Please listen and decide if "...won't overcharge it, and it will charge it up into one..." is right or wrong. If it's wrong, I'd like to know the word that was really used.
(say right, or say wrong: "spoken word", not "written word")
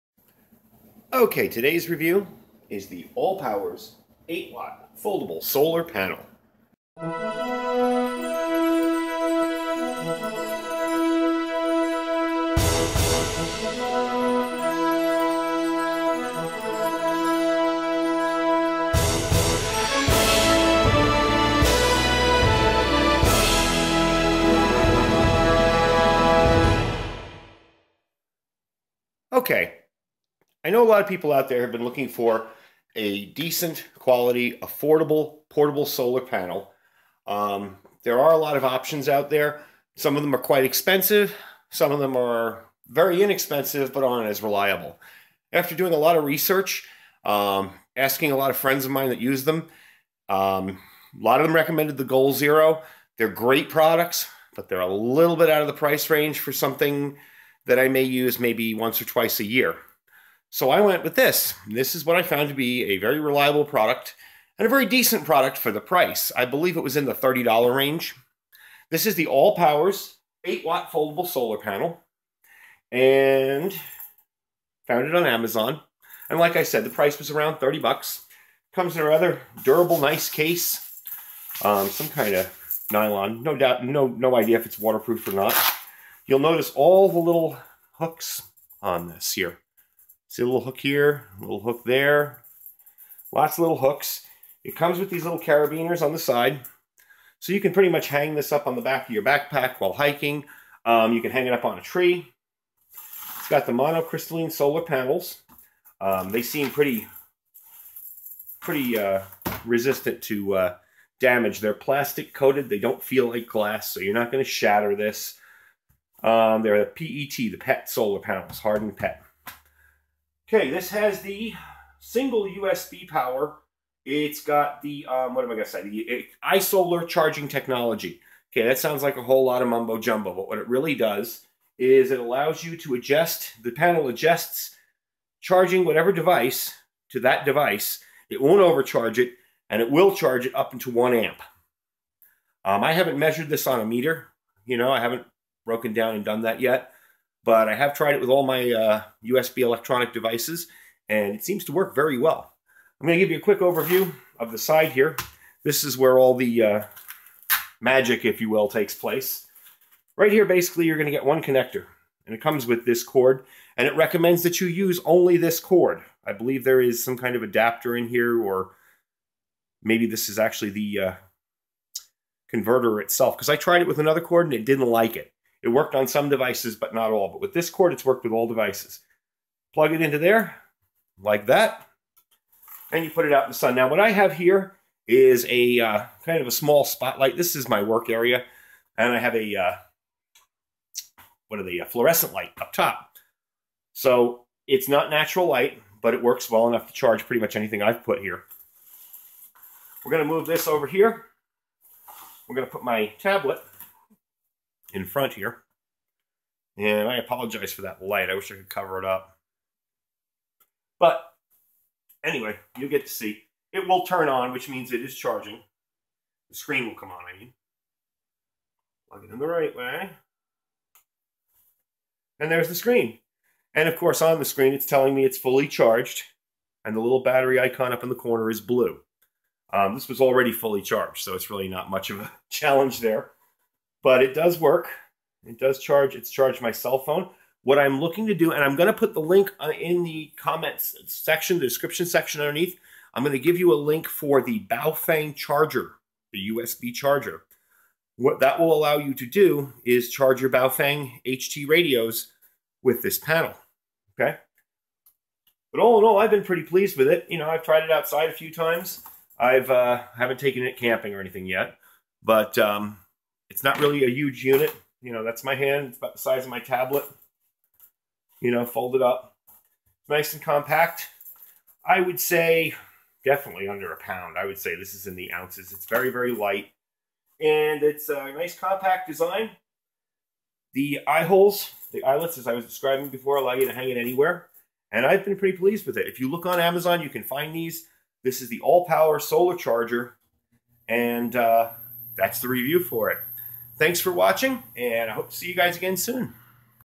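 right.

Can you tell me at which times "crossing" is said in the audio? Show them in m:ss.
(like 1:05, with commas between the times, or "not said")
not said.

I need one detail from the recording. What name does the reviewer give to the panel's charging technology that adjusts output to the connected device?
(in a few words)
iSolar.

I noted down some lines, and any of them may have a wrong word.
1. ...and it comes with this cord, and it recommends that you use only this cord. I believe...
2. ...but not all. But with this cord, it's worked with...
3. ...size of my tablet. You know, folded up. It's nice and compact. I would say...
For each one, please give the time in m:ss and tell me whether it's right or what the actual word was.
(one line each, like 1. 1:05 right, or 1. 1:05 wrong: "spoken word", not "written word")
1. 2:42 right
2. 2:56 right
3. 4:26 right.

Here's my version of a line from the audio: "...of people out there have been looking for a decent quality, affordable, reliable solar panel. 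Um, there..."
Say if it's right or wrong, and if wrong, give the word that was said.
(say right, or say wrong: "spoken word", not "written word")
wrong: "portable", not "reliable".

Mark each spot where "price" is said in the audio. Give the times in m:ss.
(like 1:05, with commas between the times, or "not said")
0:55, 1:05, 1:16.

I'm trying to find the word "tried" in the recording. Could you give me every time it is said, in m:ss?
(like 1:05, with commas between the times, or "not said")
2:27, 2:53, 4:17.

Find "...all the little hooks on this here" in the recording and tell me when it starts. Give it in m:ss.
1:26.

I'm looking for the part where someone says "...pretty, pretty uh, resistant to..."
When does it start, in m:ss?
1:46.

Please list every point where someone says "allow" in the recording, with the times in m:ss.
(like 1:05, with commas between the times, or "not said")
2:12, 4:08, 4:43.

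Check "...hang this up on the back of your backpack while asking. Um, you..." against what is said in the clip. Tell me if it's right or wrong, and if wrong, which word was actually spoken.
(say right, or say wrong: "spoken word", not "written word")
wrong: "hiking", not "asking".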